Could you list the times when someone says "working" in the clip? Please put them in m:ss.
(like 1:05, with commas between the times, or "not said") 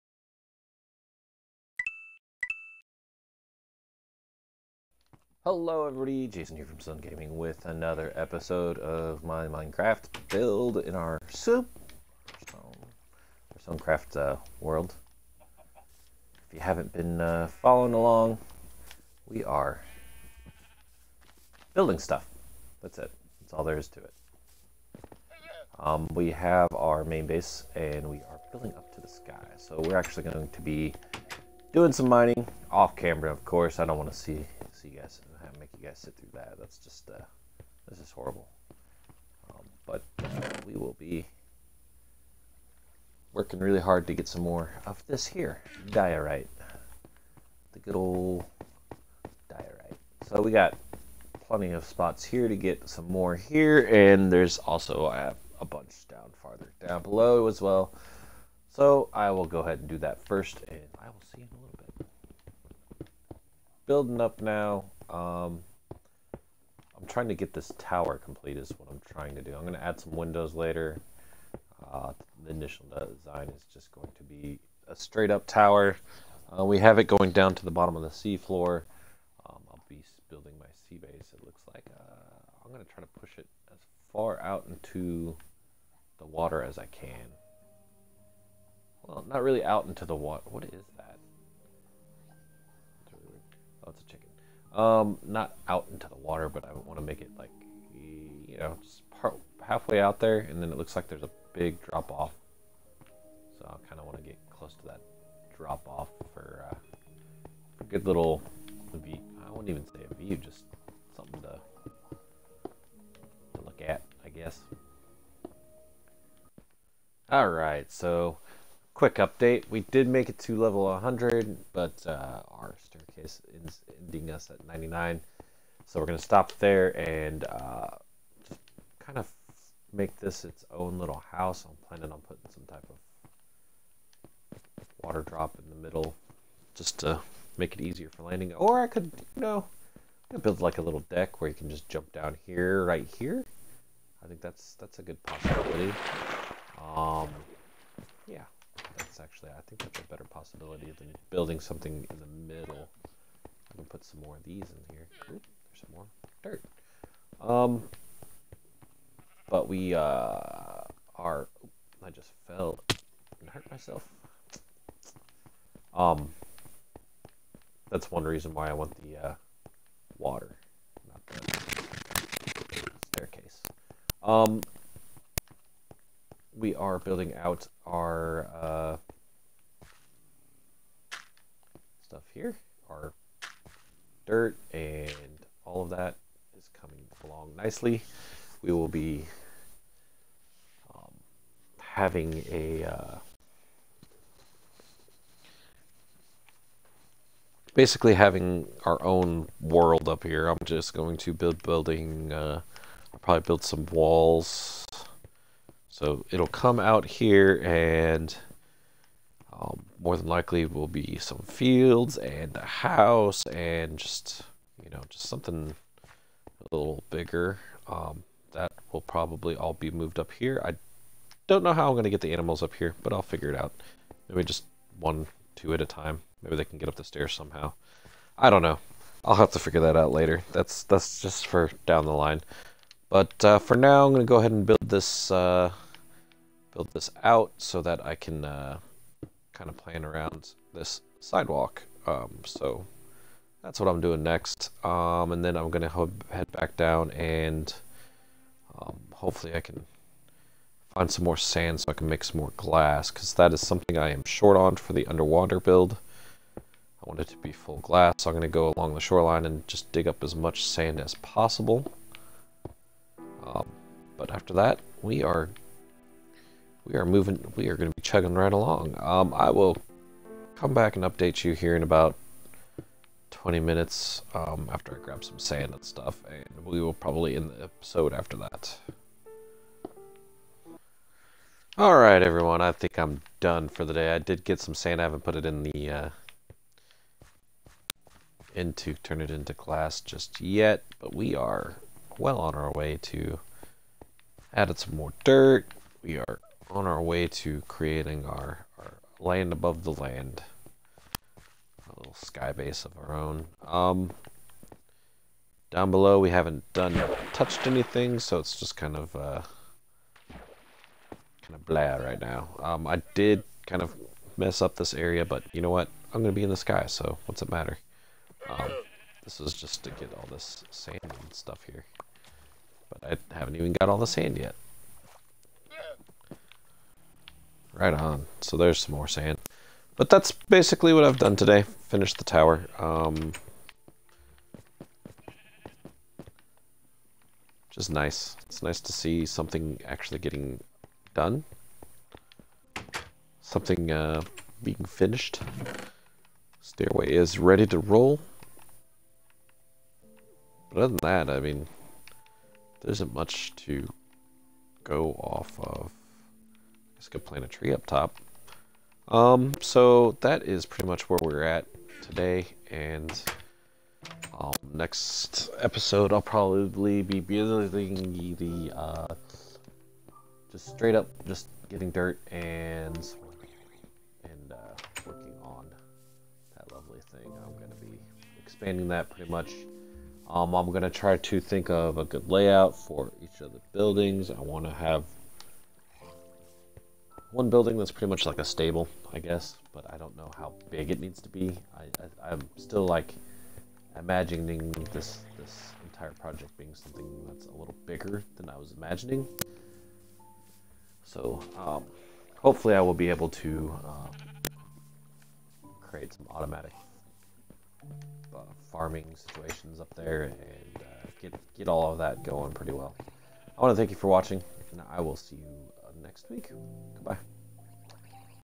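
0:43, 6:15.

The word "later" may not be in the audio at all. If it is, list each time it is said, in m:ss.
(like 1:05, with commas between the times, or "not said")
1:10, 3:50.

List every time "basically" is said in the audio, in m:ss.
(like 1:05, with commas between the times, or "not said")
3:17, 5:30.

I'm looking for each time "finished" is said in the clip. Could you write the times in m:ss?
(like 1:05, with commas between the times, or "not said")
5:31, 5:44.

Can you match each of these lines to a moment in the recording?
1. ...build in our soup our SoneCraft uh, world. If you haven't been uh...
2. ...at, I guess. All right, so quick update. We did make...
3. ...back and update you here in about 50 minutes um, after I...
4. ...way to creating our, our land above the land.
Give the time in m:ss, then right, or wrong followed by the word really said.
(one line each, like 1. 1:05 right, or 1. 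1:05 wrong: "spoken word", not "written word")
1. 0:10 right
2. 1:53 right
3. 4:30 wrong: "20", not "50"
4. 4:57 right.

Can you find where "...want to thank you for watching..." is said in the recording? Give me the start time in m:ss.
6:53.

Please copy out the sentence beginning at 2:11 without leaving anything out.
I'm planning on putting some type of water drop in the middle just to make it easier for landing.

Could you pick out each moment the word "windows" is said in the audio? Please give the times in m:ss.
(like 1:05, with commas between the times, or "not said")
1:10.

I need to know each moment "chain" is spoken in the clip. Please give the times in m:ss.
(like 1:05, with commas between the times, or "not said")
not said.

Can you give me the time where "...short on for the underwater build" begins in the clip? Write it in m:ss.
4:14.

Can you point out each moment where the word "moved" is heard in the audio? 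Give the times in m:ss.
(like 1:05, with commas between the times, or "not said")
3:39.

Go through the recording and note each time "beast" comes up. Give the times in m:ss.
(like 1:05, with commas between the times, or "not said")
not said.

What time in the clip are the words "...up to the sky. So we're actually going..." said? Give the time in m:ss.
0:28.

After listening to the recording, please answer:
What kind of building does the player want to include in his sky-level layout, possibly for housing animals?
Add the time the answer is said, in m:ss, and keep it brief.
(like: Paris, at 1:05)
stable, at 6:28.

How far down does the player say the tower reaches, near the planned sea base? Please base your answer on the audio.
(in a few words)
seafloor.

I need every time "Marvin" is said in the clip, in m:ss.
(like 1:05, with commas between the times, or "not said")
not said.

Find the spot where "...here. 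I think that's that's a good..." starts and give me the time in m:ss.
2:23.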